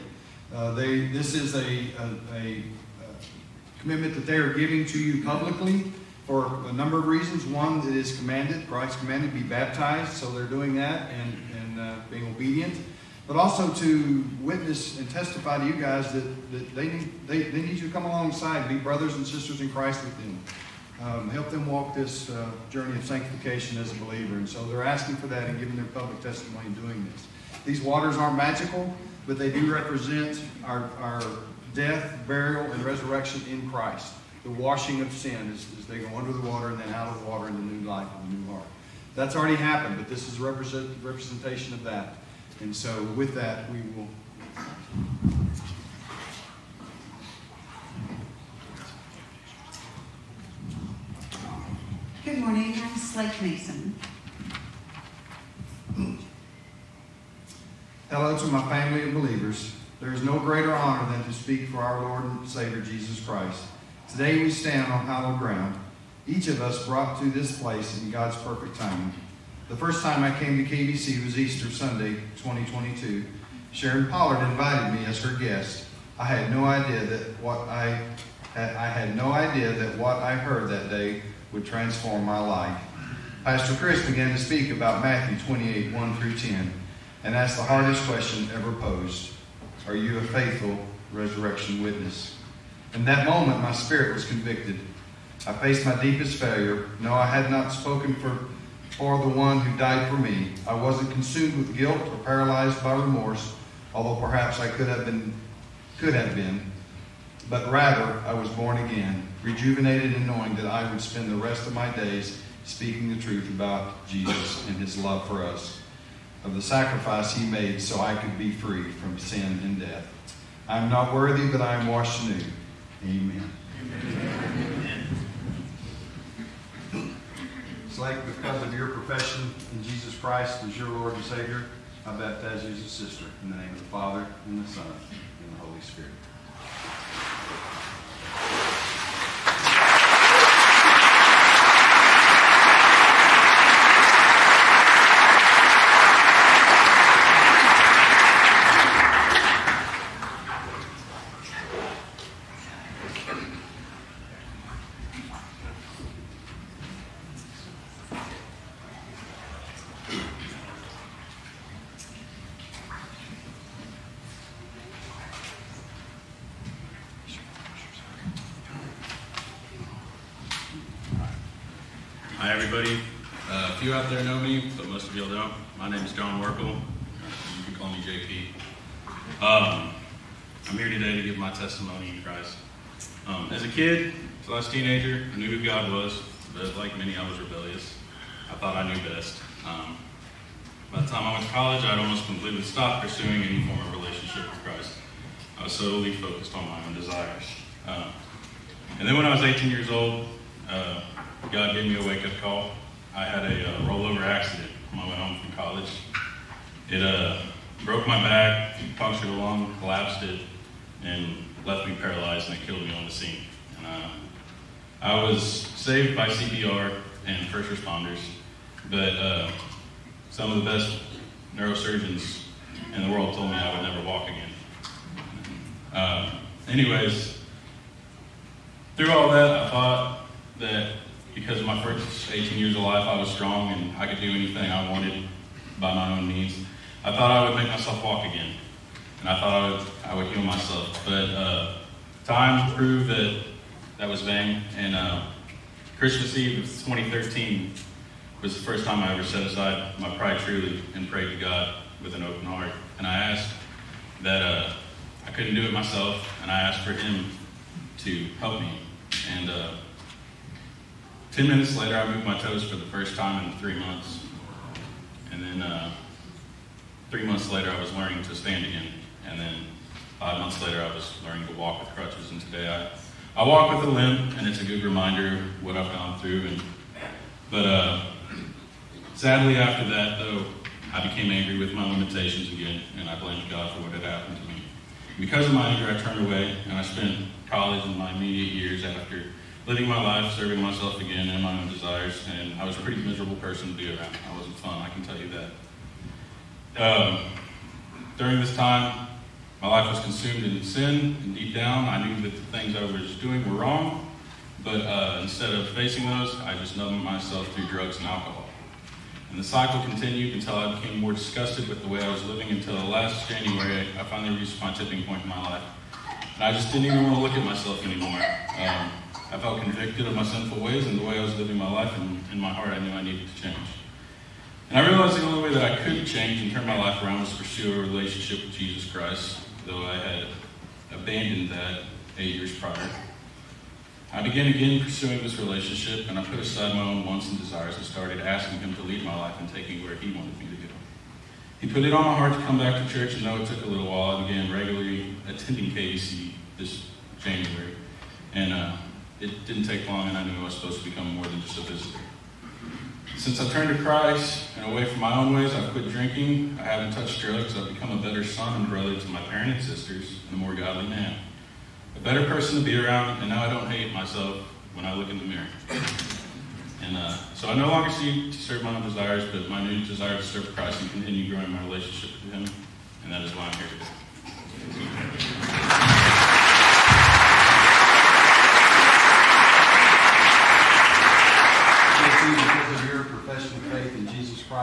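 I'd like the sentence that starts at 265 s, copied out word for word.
And then uh, three months later, I was learning to stand again.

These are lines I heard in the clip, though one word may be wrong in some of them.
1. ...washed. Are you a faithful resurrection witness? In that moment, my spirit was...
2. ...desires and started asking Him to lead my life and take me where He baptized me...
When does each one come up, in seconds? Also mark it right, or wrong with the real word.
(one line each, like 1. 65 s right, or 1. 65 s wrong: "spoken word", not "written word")
1. 88 s wrong: "posed", not "washed"
2. 337 s wrong: "wanted", not "baptized".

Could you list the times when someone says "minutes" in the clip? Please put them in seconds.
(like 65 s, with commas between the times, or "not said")
261 s.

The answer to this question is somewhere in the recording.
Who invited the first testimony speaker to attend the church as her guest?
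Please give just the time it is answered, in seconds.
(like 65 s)
73 s.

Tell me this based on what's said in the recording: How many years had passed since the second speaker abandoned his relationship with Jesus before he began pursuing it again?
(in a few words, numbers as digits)
8.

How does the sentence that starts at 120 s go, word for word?
I am not worthy, but I am washed anew.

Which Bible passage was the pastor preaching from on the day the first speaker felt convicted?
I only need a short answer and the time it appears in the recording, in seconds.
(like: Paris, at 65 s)
Matthew 28:1-10, at 85 s.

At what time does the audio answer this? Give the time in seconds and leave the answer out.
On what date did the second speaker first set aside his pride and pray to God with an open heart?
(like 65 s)
245 s.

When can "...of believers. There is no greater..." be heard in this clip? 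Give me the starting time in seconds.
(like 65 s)
59 s.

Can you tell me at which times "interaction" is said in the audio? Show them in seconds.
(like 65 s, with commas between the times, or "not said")
not said.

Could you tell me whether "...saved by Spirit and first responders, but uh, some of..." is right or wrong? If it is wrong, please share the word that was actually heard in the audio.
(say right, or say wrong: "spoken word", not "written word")
wrong: "CPR", not "Spirit".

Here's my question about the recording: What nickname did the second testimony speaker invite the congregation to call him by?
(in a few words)
JP.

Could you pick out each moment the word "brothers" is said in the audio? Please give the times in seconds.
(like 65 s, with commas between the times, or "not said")
18 s, 358 s.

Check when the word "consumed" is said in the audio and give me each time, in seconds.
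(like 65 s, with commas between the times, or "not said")
101 s, 300 s.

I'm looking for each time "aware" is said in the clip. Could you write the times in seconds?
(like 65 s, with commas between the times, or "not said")
not said.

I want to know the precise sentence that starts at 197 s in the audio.
Uh, and then when I was 18 years old, uh, God gave me a wake up call.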